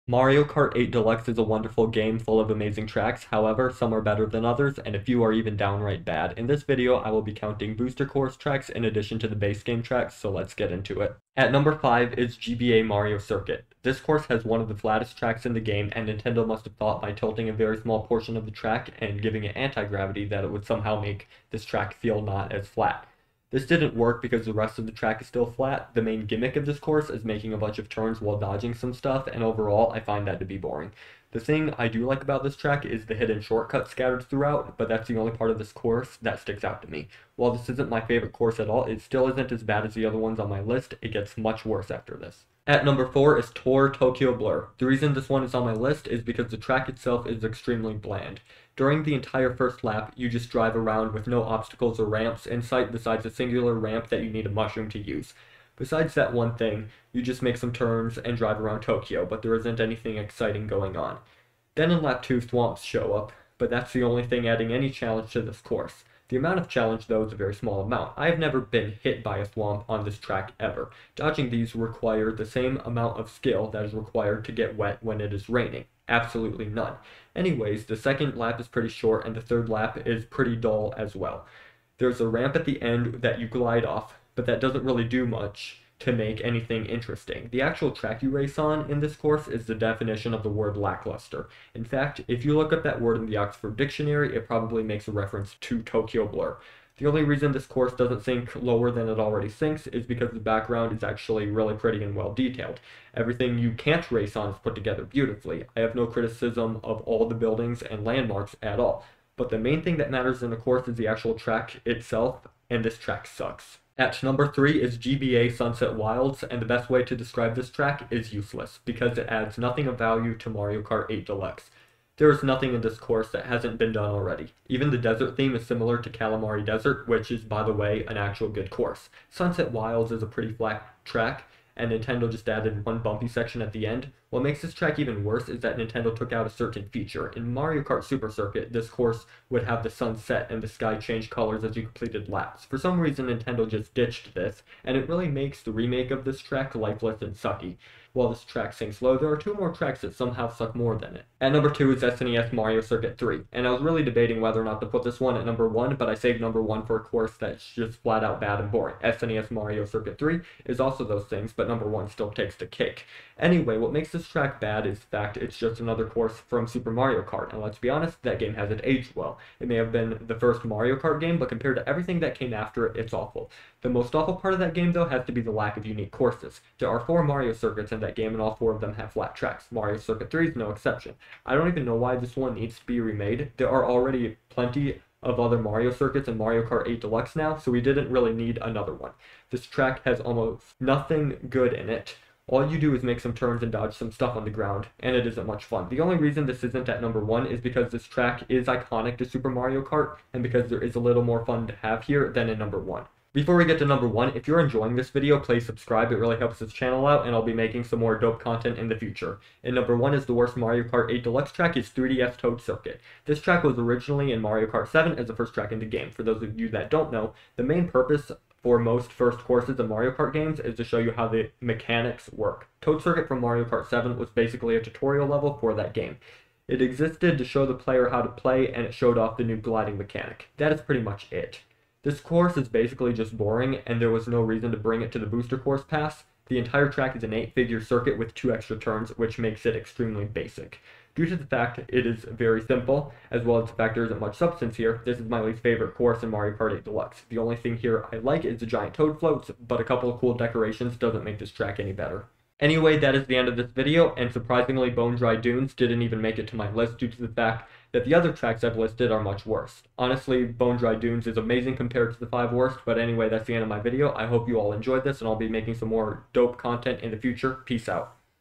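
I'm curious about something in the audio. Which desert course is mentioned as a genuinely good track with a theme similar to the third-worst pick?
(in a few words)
Kalimari Desert.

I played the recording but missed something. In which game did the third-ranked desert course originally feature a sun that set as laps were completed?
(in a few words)
Mario Kart Super Circuit.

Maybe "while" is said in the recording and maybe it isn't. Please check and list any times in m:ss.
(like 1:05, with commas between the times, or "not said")
0:28, 0:37, 2:28.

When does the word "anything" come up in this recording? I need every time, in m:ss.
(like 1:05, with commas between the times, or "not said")
0:59, 1:26.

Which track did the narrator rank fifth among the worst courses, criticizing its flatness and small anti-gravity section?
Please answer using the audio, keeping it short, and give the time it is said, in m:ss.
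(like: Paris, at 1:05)
GBA Mario Circuit, at 0:12.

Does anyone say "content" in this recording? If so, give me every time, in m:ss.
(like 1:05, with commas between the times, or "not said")
3:28, 4:26.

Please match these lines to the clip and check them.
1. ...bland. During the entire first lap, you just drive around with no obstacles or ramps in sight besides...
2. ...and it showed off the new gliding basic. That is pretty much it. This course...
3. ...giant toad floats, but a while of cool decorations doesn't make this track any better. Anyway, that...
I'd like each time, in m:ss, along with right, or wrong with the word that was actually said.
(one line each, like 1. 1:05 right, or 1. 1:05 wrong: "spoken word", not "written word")
1. 0:47 right
2. 3:48 wrong: "mechanic", not "basic"
3. 4:08 wrong: "couple", not "while".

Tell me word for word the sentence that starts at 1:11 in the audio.
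Dodging these require the same amount of skill that is required to get wet when it is raining.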